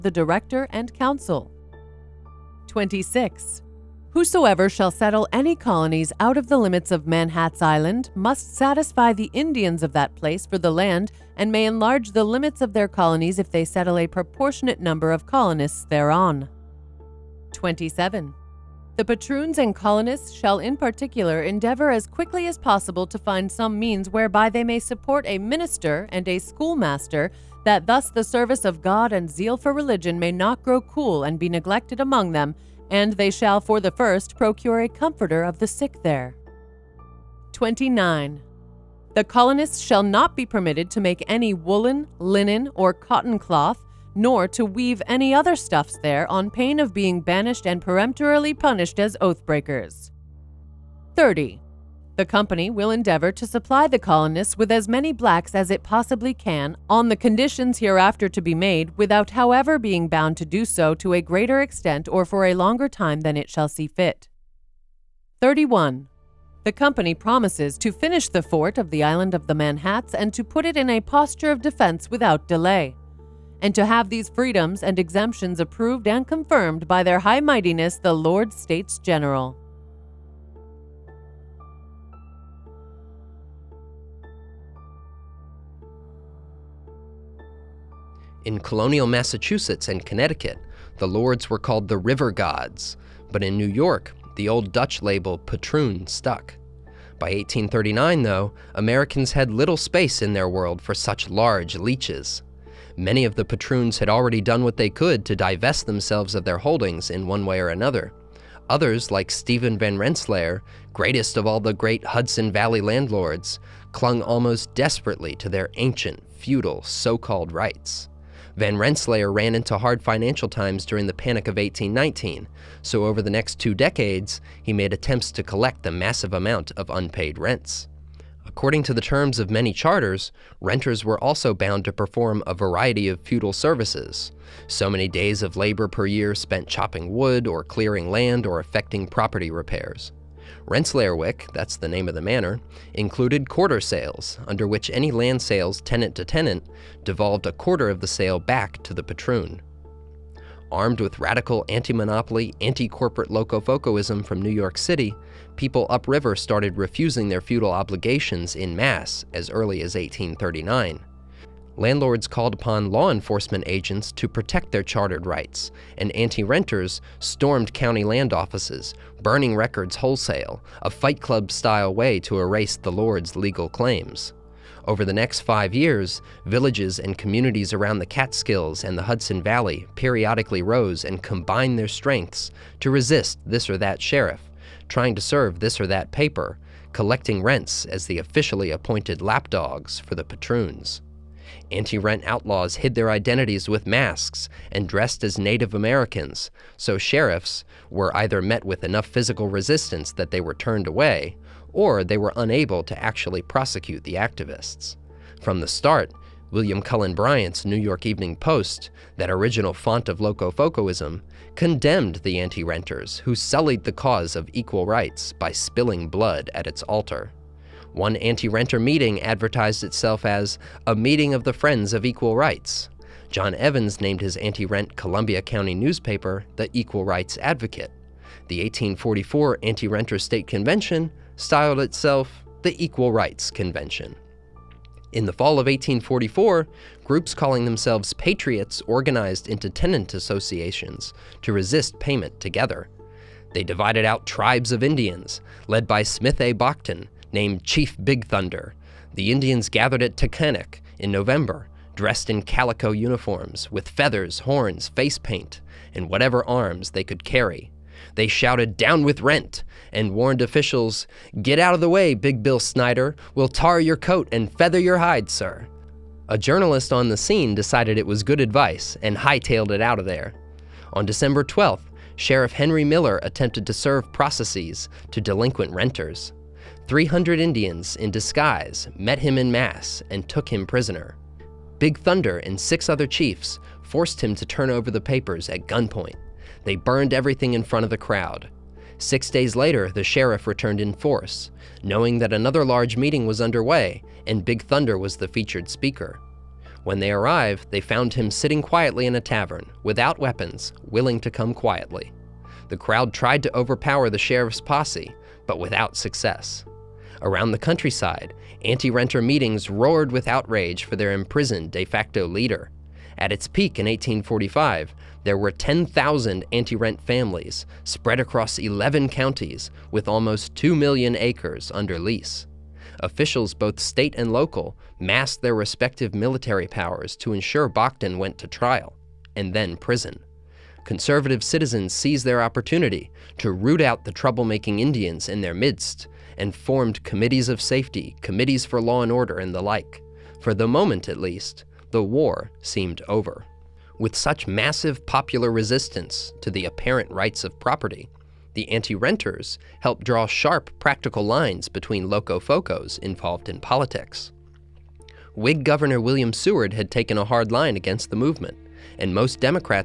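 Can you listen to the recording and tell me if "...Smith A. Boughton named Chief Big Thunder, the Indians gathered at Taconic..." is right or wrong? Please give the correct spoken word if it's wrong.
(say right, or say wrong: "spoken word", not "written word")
right.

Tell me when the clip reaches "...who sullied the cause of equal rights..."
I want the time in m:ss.
3:33.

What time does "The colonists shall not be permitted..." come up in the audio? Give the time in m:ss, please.
0:39.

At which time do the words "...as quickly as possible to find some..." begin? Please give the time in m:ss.
0:21.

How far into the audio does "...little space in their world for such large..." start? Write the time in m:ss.
1:39.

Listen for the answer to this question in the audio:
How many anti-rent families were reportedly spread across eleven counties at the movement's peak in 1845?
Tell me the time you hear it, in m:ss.
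5:15.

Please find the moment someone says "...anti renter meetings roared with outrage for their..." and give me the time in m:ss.
5:08.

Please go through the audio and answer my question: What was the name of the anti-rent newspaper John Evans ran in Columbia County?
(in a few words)
Equal Rights Advocate.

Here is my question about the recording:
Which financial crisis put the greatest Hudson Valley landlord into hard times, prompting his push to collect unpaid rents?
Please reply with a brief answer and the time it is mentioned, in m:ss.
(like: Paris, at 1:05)
Panic of 1819, at 2:01.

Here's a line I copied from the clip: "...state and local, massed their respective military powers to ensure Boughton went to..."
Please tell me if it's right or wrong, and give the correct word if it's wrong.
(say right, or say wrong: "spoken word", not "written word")
right.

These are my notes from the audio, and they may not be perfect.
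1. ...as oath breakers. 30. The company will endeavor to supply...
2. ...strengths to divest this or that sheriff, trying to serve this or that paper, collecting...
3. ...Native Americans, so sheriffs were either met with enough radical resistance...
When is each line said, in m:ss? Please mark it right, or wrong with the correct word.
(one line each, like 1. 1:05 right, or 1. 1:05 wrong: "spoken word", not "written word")
1. 0:48 right
2. 3:01 wrong: "resist", not "divest"
3. 3:15 wrong: "physical", not "radical".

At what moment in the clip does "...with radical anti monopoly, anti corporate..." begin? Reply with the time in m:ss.
2:30.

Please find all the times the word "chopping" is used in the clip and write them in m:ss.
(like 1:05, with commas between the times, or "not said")
2:16.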